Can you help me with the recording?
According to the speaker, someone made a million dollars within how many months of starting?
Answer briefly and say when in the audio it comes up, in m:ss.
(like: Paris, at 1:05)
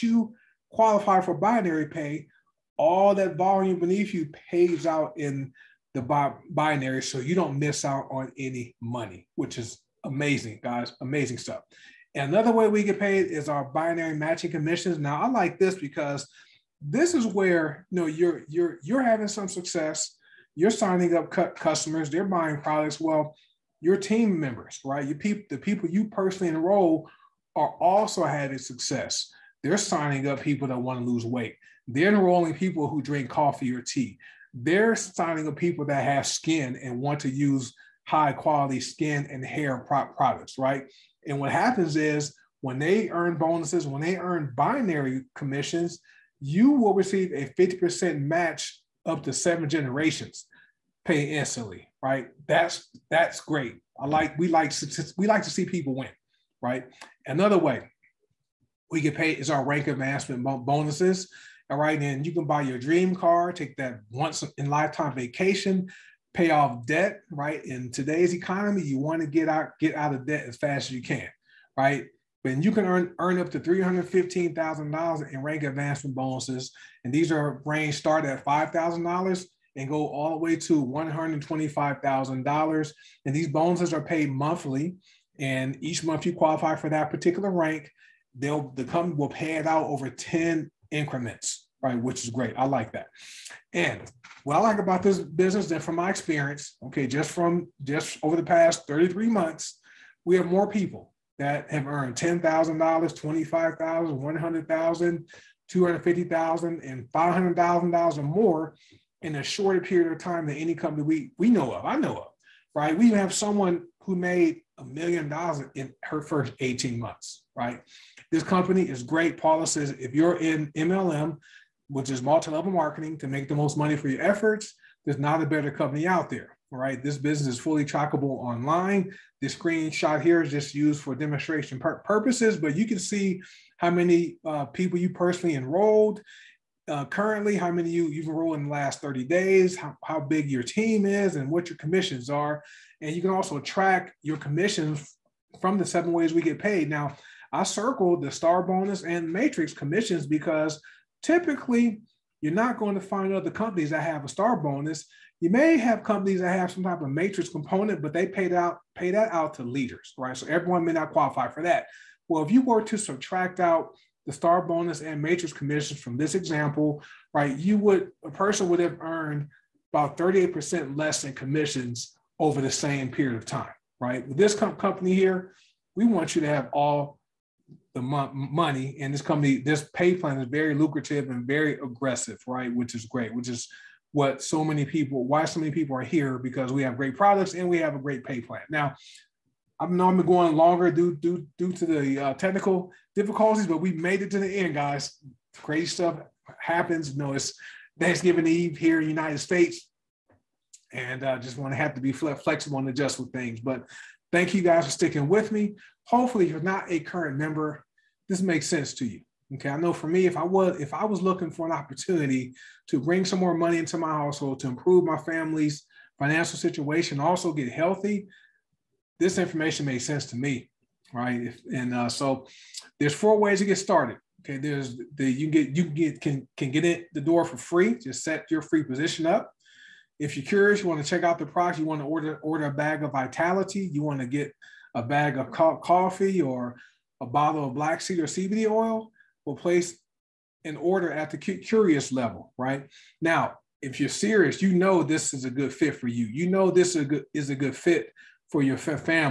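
18 months, at 1:56.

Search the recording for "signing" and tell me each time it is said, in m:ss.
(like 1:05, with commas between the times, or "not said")
0:20, 0:29, 0:34.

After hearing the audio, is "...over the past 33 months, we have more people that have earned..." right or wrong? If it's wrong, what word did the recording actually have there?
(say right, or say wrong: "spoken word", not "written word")
right.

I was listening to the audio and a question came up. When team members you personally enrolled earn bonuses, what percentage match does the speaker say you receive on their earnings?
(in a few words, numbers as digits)
50%.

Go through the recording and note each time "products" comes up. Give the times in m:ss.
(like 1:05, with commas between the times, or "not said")
0:22, 0:40, 3:07, 3:51.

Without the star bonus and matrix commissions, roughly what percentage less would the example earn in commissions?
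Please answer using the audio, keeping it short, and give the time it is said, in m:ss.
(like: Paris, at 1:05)
38%, at 2:50.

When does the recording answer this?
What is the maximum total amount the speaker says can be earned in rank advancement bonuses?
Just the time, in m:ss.
1:13.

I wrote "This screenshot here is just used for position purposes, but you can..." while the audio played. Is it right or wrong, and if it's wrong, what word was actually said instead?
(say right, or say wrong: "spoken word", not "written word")
wrong: "demonstration", not "position".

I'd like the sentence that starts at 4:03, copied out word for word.
Now, if you're serious, you know this is a good fit for you.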